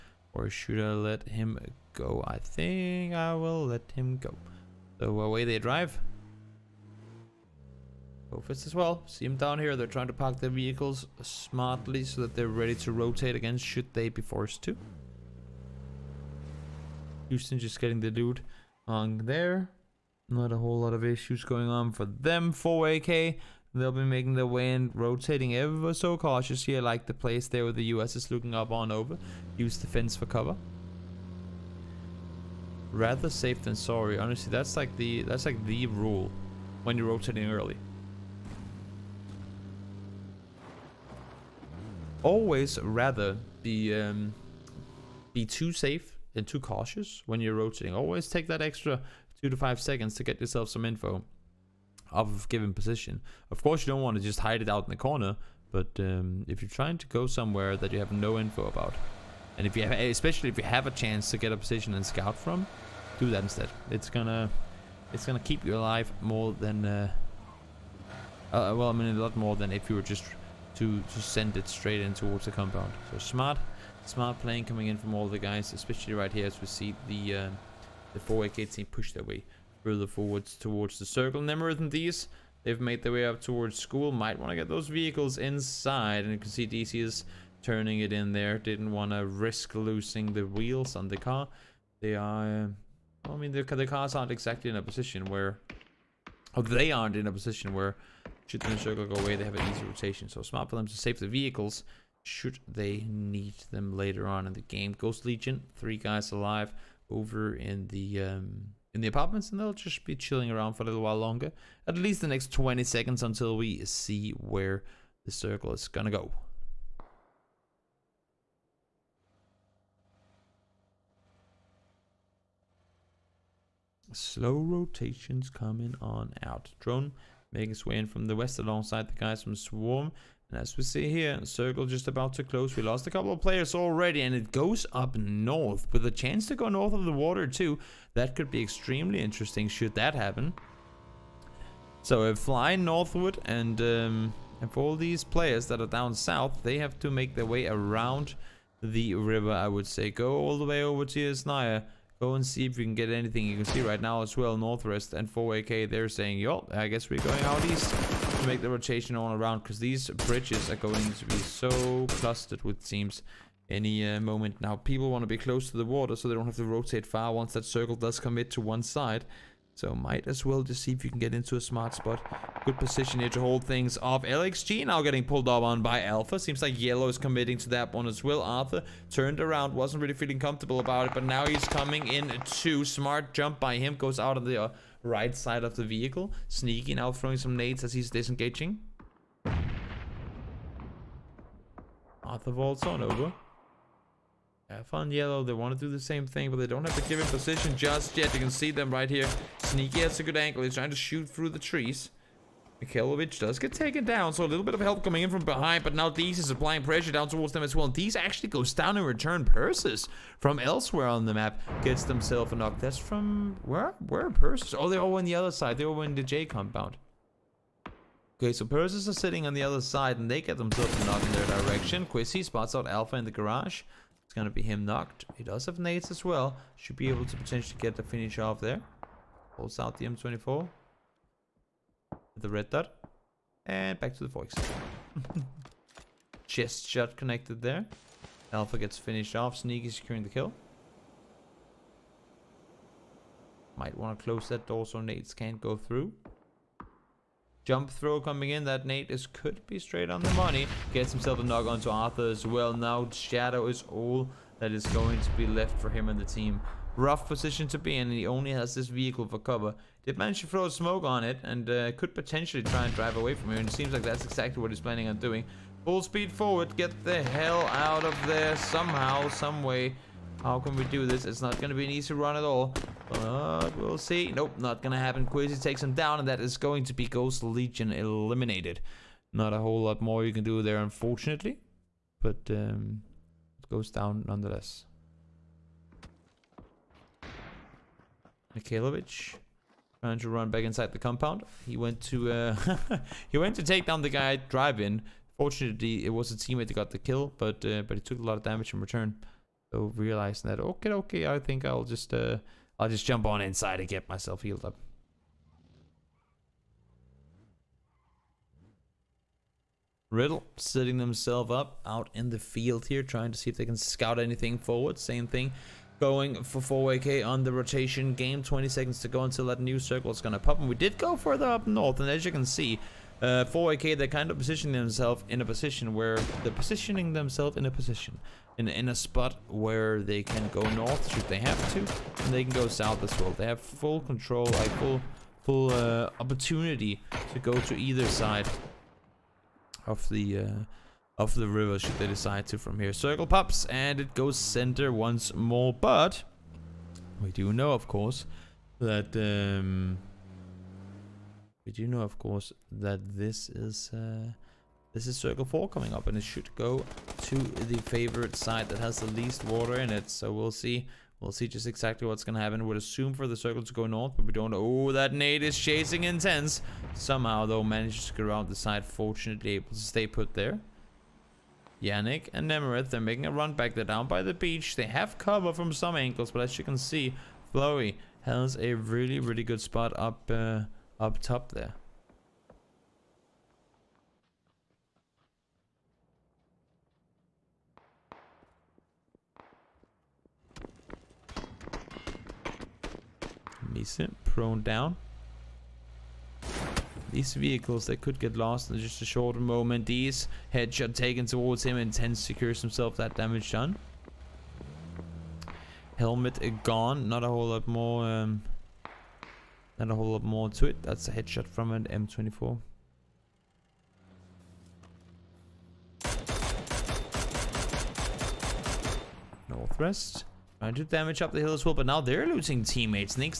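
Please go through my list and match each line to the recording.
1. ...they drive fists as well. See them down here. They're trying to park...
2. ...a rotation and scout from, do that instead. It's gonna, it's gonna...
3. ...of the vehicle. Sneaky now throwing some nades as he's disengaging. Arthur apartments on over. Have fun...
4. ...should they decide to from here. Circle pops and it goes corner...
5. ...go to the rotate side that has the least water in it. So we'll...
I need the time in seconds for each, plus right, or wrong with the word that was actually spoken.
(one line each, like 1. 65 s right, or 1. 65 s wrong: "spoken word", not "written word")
1. 5 s right
2. 61 s wrong: "position", not "rotation"
3. 185 s wrong: "vaults", not "apartments"
4. 341 s wrong: "center", not "corner"
5. 356 s wrong: "favorite", not "rotate".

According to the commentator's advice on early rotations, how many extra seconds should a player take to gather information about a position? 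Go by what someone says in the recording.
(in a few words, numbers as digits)
2 to 5.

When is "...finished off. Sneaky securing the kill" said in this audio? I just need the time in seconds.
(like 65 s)
238 s.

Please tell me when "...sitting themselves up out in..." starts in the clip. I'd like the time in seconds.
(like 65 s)
310 s.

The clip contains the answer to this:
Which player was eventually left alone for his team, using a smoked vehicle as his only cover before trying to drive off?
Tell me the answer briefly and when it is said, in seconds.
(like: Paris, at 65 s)
Shadow, at 253 s.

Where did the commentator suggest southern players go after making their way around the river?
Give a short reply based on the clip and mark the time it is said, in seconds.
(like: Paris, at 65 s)
Yasnaya, at 151 s.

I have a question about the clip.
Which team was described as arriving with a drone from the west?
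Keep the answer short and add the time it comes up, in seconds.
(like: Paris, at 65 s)
Swarm, at 129 s.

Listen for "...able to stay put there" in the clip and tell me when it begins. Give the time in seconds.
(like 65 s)
369 s.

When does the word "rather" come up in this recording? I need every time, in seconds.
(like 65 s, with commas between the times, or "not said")
32 s, 42 s.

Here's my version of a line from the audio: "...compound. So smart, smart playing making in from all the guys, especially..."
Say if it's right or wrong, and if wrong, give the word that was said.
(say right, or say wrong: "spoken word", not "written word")
wrong: "coming", not "making".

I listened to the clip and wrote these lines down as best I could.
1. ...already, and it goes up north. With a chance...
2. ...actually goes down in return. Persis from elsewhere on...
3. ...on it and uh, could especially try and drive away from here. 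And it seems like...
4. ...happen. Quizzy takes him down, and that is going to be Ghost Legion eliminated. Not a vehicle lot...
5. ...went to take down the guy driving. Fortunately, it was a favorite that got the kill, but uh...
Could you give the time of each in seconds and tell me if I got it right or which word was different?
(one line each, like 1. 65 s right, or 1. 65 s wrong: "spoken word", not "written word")
1. 133 s right
2. 208 s right
3. 261 s wrong: "potentially", not "especially"
4. 274 s wrong: "whole", not "vehicle"
5. 293 s wrong: "teammate", not "favorite".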